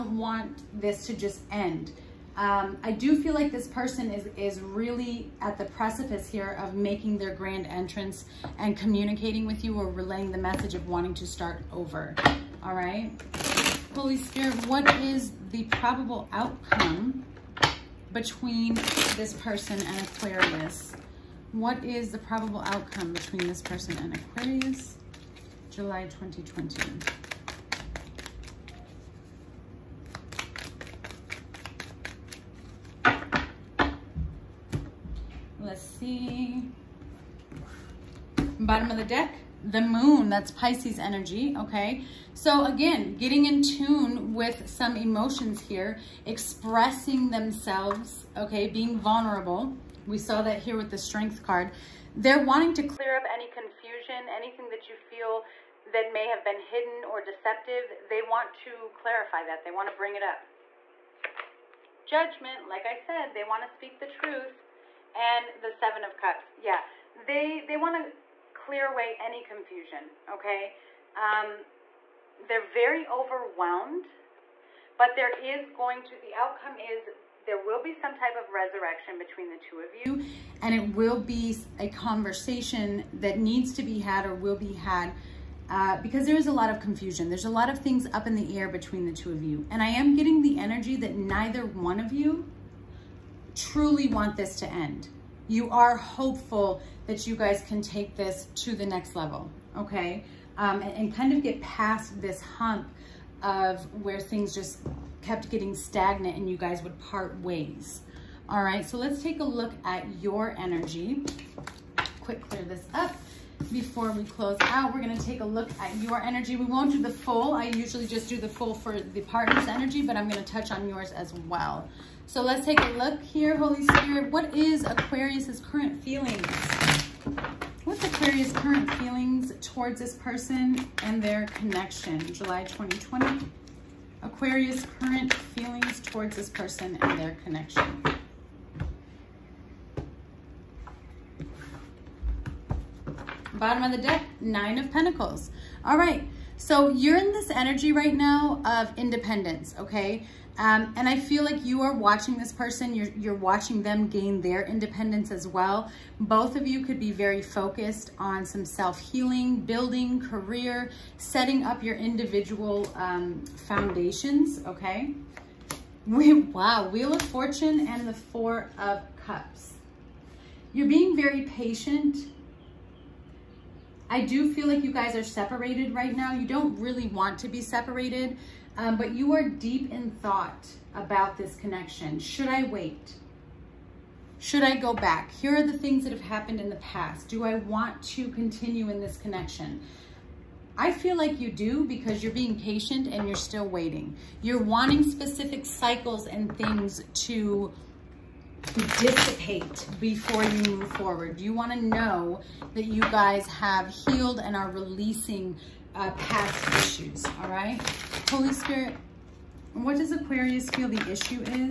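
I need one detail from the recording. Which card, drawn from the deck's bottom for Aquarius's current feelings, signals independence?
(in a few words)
Nine of Pentacles.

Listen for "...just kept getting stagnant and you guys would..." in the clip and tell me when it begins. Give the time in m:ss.
1:44.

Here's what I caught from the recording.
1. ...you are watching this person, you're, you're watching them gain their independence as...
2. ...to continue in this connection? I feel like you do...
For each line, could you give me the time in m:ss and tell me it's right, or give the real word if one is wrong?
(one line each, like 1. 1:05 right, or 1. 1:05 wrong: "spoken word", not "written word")
1. 2:31 right
2. 3:08 right.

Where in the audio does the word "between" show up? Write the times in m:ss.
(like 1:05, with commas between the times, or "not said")
0:18, 0:23, 1:19, 1:28.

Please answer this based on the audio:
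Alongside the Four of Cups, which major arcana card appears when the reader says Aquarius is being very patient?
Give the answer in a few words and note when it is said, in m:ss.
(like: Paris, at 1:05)
Wheel of Fortune, at 2:46.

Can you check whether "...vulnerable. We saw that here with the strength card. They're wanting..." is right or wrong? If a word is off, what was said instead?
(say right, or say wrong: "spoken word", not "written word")
right.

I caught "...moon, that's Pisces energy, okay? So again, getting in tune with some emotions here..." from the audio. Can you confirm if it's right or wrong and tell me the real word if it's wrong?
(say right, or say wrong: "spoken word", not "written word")
right.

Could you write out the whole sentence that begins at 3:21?
You want to know that you guys have healed and are releasing uh, past issues, all right?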